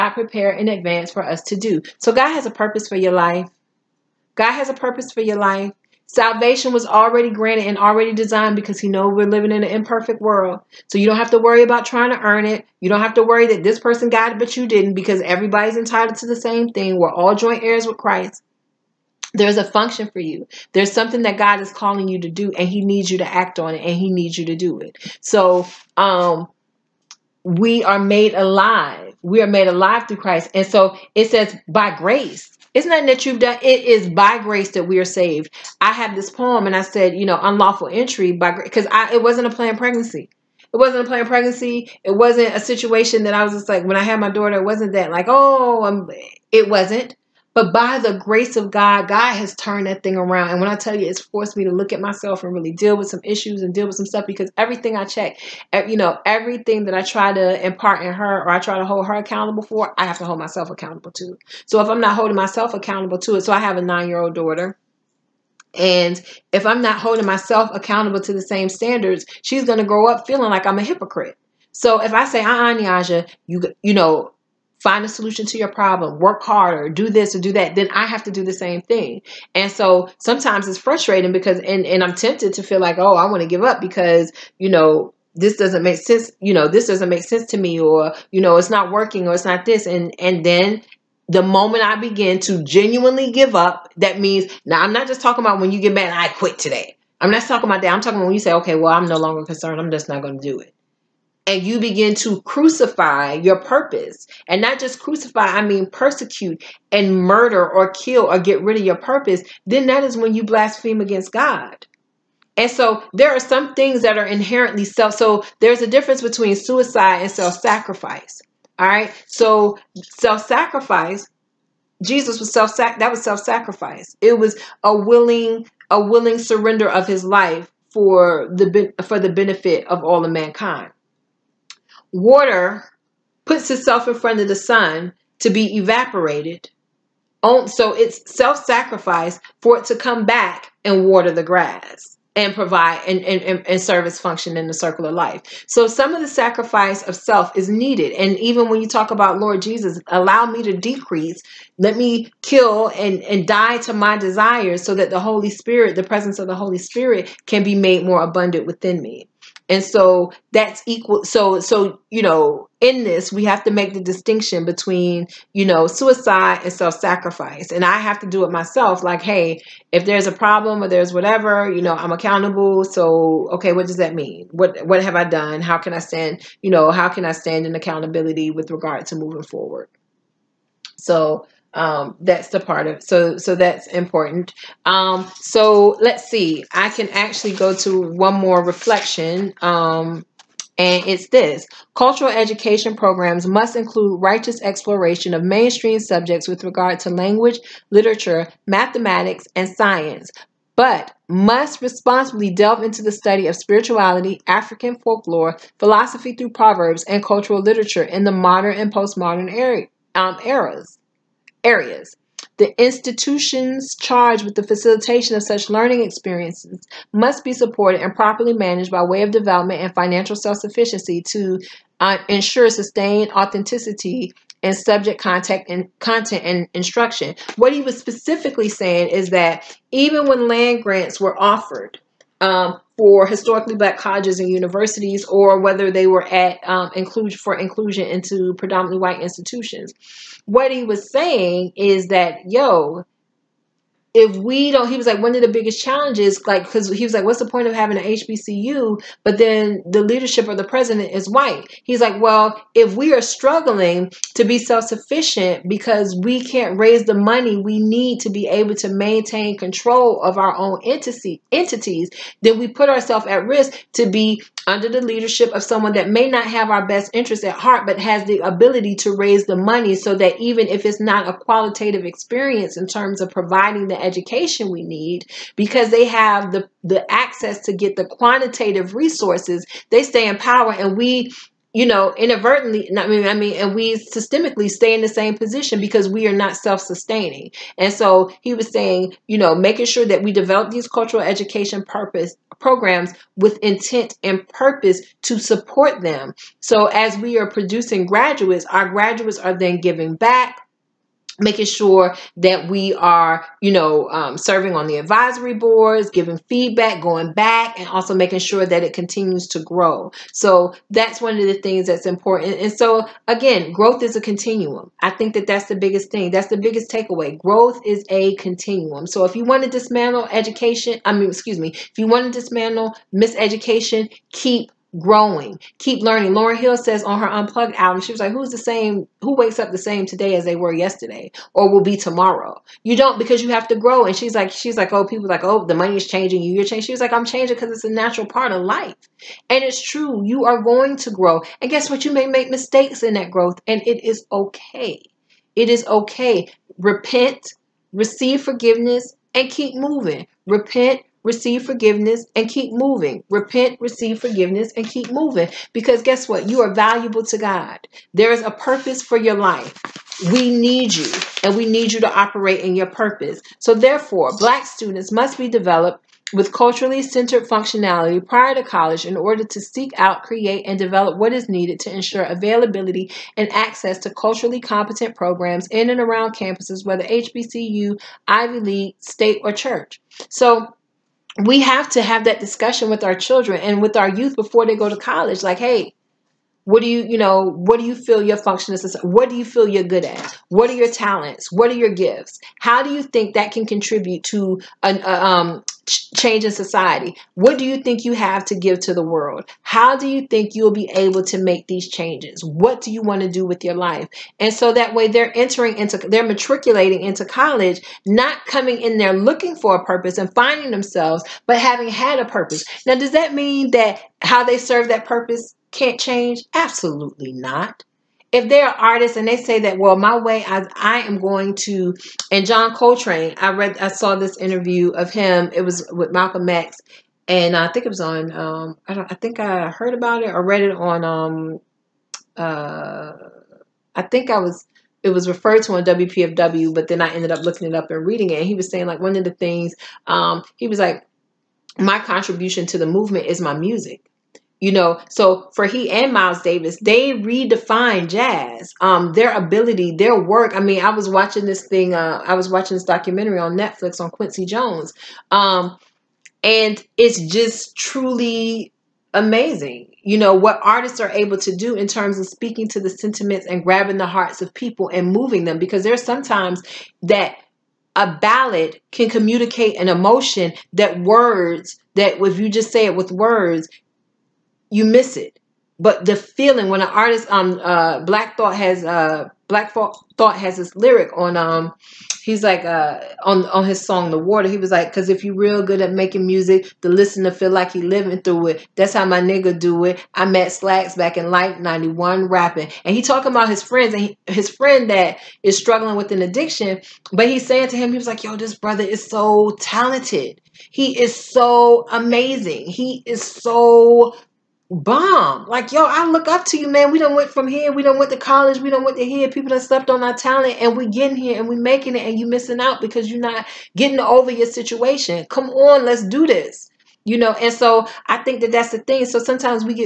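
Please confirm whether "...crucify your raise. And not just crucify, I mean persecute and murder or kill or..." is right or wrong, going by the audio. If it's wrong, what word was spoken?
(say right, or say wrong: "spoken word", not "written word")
wrong: "purpose", not "raise".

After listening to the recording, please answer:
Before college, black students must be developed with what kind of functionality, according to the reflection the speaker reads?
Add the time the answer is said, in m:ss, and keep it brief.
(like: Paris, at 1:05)
Culturally centered functionality, at 6:06.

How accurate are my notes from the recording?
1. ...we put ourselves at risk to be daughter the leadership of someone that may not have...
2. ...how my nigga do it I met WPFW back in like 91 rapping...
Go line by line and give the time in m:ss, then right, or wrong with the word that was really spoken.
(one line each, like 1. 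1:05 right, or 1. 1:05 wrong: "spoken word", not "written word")
1. 4:22 wrong: "under", not "daughter"
2. 8:08 wrong: "Slacks", not "WPFW".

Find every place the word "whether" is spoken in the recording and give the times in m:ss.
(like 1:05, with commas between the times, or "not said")
3:55, 6:16.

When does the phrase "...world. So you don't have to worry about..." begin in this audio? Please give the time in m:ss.
0:10.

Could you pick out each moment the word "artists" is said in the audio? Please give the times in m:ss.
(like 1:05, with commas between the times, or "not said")
6:58, 7:40, 7:56.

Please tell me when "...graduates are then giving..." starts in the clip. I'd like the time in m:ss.
4:58.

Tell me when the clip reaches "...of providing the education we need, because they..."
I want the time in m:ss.
4:33.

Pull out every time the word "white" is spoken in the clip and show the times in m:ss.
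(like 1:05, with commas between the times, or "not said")
3:58, 4:11.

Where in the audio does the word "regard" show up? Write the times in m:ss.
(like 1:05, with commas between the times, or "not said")
2:58, 3:16.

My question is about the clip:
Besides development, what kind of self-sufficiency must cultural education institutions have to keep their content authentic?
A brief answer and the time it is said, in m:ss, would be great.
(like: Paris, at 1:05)
Financial, at 3:39.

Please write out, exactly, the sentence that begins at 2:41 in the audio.
So, so, you know, in this, we have to make the distinction between, you know, suicide and self sacrifice.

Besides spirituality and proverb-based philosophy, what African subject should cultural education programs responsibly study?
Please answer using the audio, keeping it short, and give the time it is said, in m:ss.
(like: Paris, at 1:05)
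African folklore, at 3:24.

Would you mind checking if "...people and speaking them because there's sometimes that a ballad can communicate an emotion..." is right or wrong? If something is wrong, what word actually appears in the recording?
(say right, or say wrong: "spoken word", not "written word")
wrong: "moving", not "speaking".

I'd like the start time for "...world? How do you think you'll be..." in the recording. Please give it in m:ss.
6:39.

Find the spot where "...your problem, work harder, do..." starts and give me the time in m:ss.
1:15.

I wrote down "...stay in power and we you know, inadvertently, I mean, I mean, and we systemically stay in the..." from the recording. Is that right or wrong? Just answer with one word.
right.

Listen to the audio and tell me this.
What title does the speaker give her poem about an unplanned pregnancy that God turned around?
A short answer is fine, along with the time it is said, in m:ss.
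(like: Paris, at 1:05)
Unlawful Entry by Grace, at 0:37.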